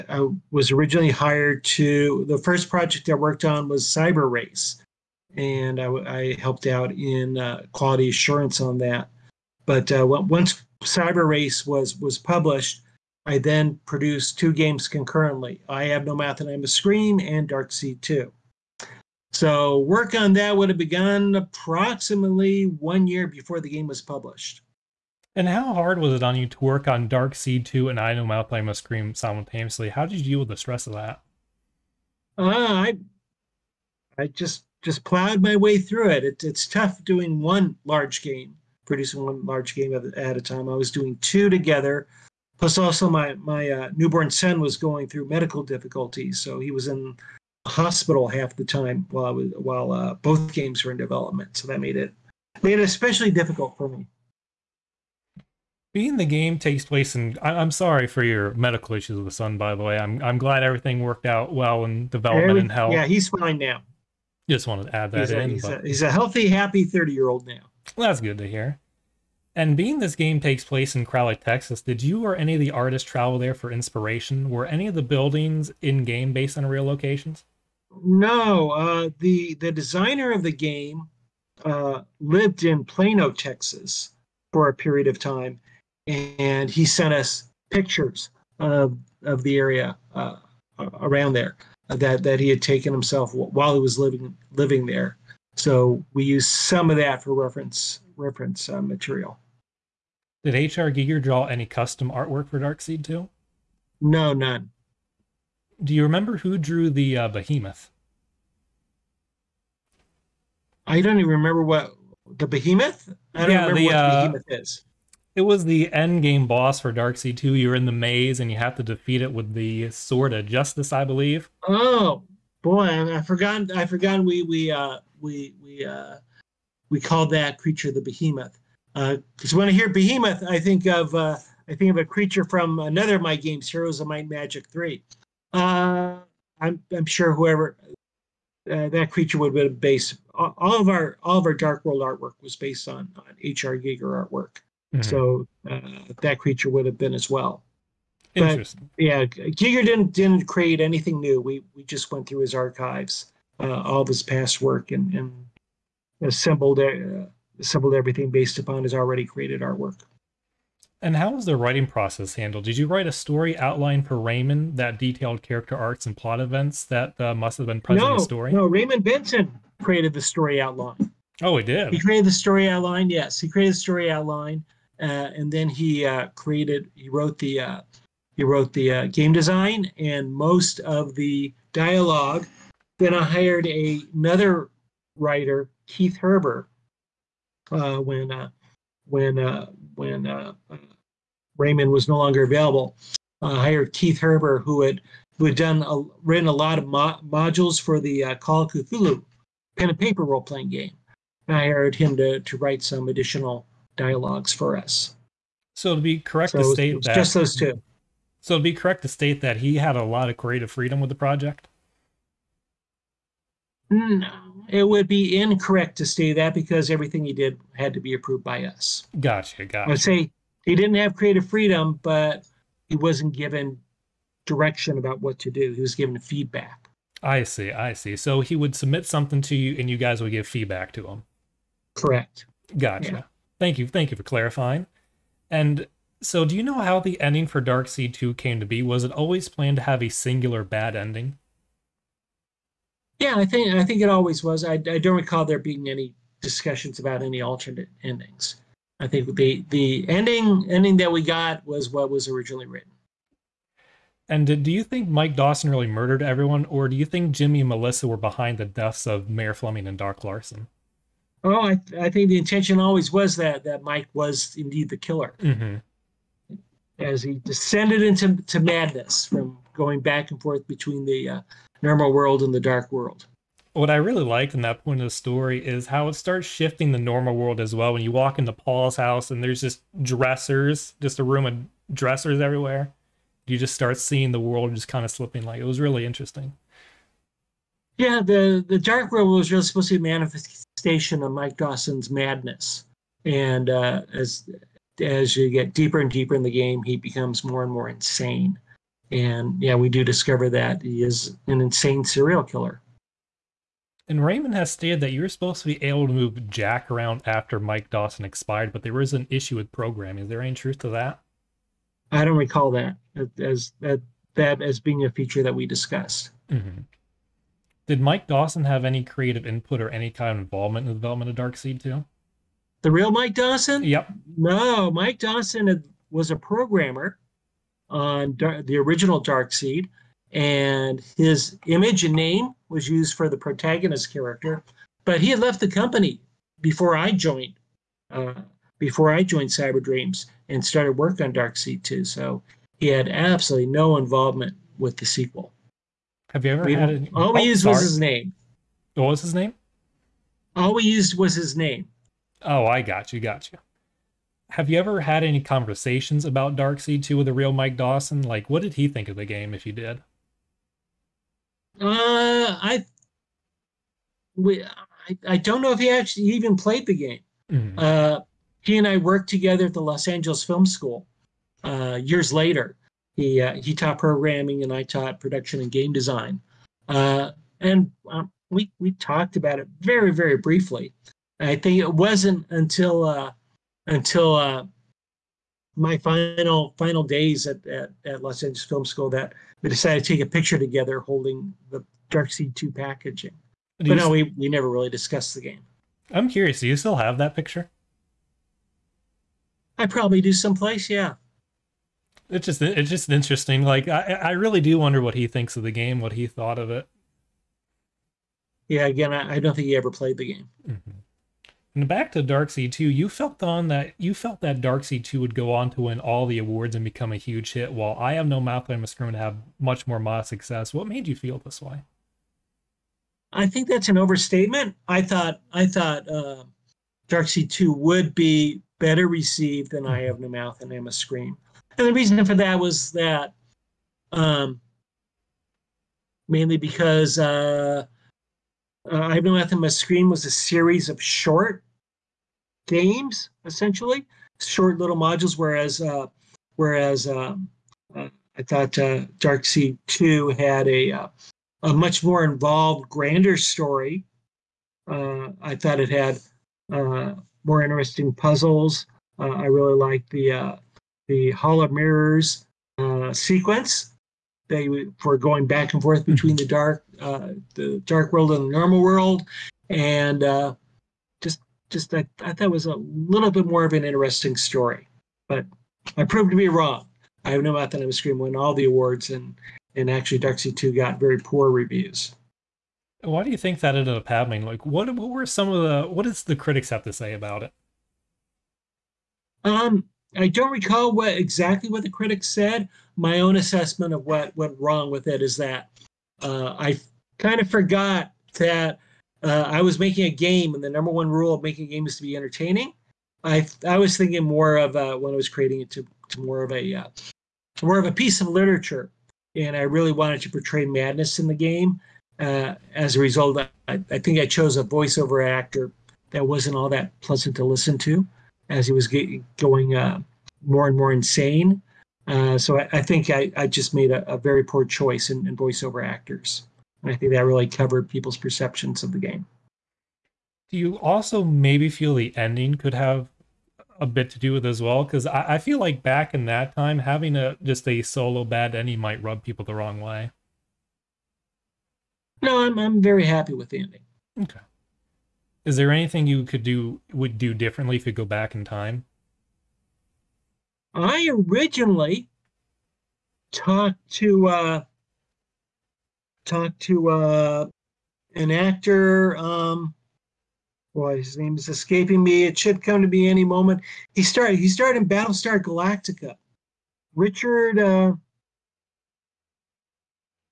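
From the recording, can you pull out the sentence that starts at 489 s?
Um, I don't recall what exactly what the critics said.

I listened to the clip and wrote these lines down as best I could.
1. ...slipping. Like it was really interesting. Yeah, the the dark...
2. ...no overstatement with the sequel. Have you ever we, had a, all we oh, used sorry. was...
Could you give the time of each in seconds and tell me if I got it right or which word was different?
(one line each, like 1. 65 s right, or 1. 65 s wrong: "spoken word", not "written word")
1. 285 s right
2. 343 s wrong: "involvement", not "overstatement".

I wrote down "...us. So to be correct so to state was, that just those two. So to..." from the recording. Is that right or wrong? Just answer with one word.
right.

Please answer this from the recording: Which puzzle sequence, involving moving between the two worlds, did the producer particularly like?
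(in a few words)
Hall of Mirrors.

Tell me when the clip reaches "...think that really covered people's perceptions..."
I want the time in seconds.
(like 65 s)
526 s.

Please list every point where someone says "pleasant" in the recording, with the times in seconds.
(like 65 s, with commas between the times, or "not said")
517 s.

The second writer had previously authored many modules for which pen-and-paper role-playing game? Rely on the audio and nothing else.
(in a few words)
Call of Cthulhu.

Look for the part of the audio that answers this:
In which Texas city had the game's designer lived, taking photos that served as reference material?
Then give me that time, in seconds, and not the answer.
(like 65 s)
82 s.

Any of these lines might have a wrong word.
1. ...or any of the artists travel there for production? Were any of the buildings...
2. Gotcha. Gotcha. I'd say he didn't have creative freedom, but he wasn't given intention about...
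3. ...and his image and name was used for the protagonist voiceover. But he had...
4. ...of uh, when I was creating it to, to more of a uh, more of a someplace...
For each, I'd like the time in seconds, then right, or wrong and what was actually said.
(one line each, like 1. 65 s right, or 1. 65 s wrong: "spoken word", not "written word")
1. 72 s wrong: "inspiration", not "production"
2. 219 s wrong: "direction", not "intention"
3. 330 s wrong: "character", not "voiceover"
4. 504 s wrong: "piece", not "someplace".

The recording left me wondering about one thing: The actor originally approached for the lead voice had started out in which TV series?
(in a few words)
Battlestar Galactica.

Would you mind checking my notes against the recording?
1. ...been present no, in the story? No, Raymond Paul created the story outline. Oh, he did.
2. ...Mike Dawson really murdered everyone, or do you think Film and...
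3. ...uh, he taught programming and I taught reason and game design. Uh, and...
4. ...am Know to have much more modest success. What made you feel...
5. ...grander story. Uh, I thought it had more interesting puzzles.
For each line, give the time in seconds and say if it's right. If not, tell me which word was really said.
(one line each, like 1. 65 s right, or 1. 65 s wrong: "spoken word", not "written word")
1. 167 s wrong: "Benson", not "Paul"
2. 255 s wrong: "Jimmy", not "Film"
3. 373 s wrong: "production", not "reason"
4. 418 s wrong: "Screen", not "Know"
5. 452 s right.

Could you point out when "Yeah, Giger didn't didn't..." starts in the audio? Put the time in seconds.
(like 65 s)
148 s.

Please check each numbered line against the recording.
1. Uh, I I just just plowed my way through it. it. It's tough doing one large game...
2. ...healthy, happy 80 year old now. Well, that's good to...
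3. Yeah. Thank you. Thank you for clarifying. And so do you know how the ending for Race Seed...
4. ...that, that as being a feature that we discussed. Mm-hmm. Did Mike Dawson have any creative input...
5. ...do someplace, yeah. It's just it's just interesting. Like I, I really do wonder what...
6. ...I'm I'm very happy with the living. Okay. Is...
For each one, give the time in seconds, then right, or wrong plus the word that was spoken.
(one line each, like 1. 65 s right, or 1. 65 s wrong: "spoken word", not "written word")
1. 32 s right
2. 66 s wrong: "30", not "80"
3. 233 s wrong: "Dark", not "Race"
4. 313 s right
5. 400 s right
6. 542 s wrong: "ending", not "living".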